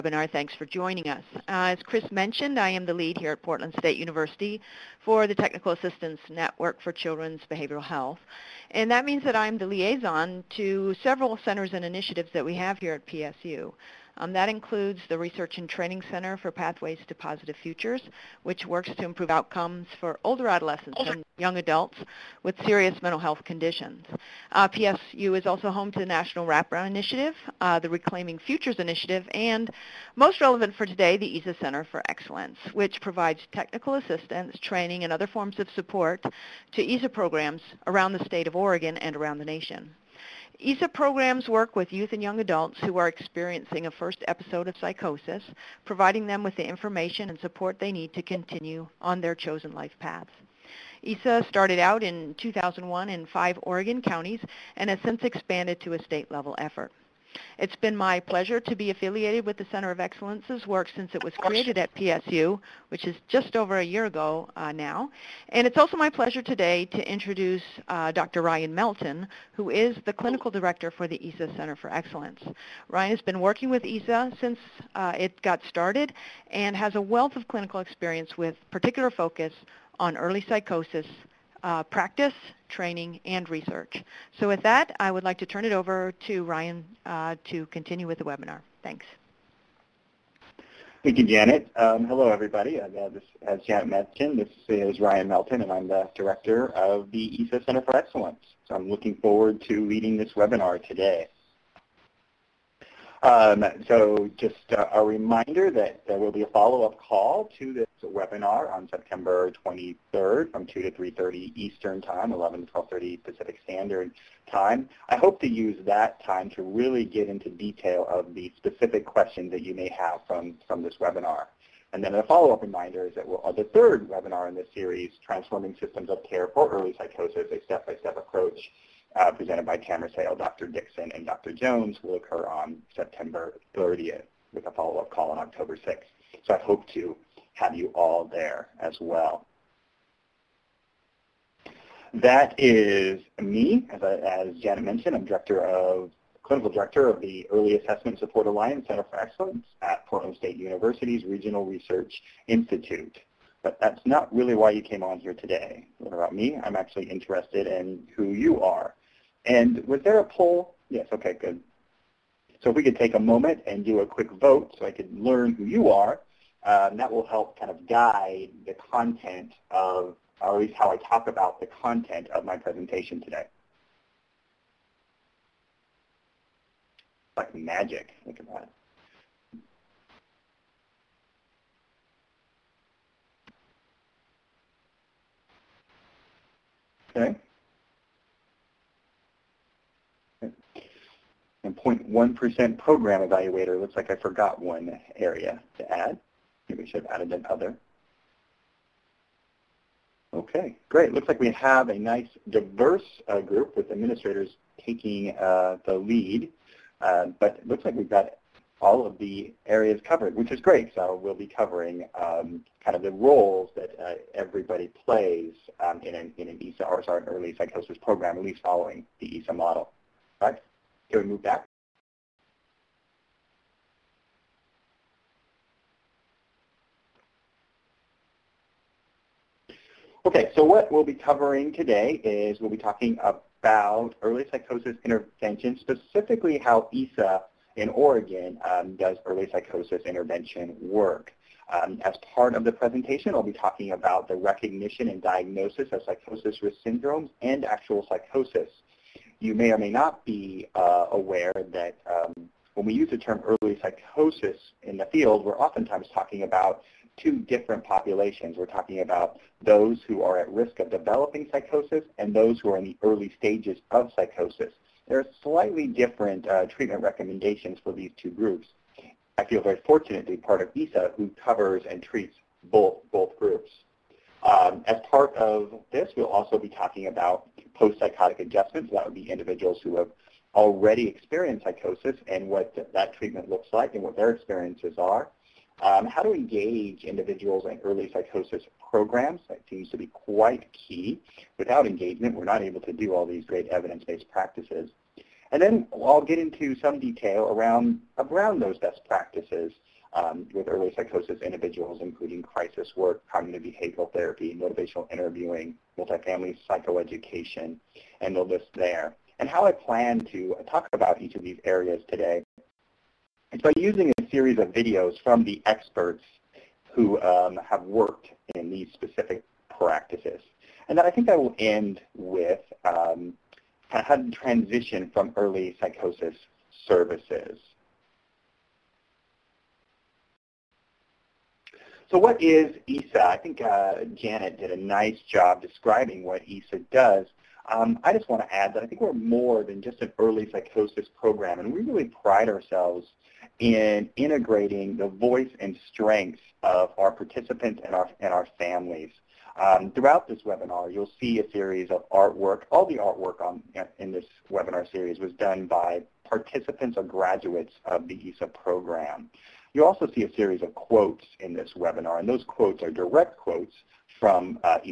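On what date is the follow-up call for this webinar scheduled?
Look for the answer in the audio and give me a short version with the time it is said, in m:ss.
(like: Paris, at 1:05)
September 23rd, at 1:48.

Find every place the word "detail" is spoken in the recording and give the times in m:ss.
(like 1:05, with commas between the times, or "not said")
1:57, 4:56.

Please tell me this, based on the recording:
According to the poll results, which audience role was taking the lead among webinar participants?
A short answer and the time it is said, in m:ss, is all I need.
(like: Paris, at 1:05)
administrators, at 3:23.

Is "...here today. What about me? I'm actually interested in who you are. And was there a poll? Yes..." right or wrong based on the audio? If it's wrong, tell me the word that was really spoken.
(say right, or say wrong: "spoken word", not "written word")
right.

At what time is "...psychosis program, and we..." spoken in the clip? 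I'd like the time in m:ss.
5:40.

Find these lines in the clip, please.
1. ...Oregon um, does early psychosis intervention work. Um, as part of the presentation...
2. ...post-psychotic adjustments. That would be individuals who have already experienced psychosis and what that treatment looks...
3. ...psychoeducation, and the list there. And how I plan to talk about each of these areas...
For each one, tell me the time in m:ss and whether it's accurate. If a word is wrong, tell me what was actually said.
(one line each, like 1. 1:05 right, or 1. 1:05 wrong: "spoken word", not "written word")
1. 3:57 right
2. 4:37 right
3. 5:06 right.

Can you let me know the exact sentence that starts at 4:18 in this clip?
We're talking about those who are at risk of developing psychosis and those who are in the early stages of psychosis.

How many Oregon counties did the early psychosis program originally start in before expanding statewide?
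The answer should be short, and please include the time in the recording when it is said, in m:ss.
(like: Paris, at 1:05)
5, at 0:53.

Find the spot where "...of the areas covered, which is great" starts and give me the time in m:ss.
3:29.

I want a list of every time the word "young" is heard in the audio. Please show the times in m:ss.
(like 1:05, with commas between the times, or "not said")
0:21, 0:42.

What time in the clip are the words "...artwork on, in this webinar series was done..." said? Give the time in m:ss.
5:52.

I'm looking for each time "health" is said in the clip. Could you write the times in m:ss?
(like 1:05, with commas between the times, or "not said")
0:07, 0:23.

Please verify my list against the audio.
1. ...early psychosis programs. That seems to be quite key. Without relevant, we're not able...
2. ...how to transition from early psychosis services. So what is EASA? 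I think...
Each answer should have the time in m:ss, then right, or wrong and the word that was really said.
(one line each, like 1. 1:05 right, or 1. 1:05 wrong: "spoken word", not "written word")
1. 4:47 wrong: "engagement", not "relevant"
2. 5:23 right.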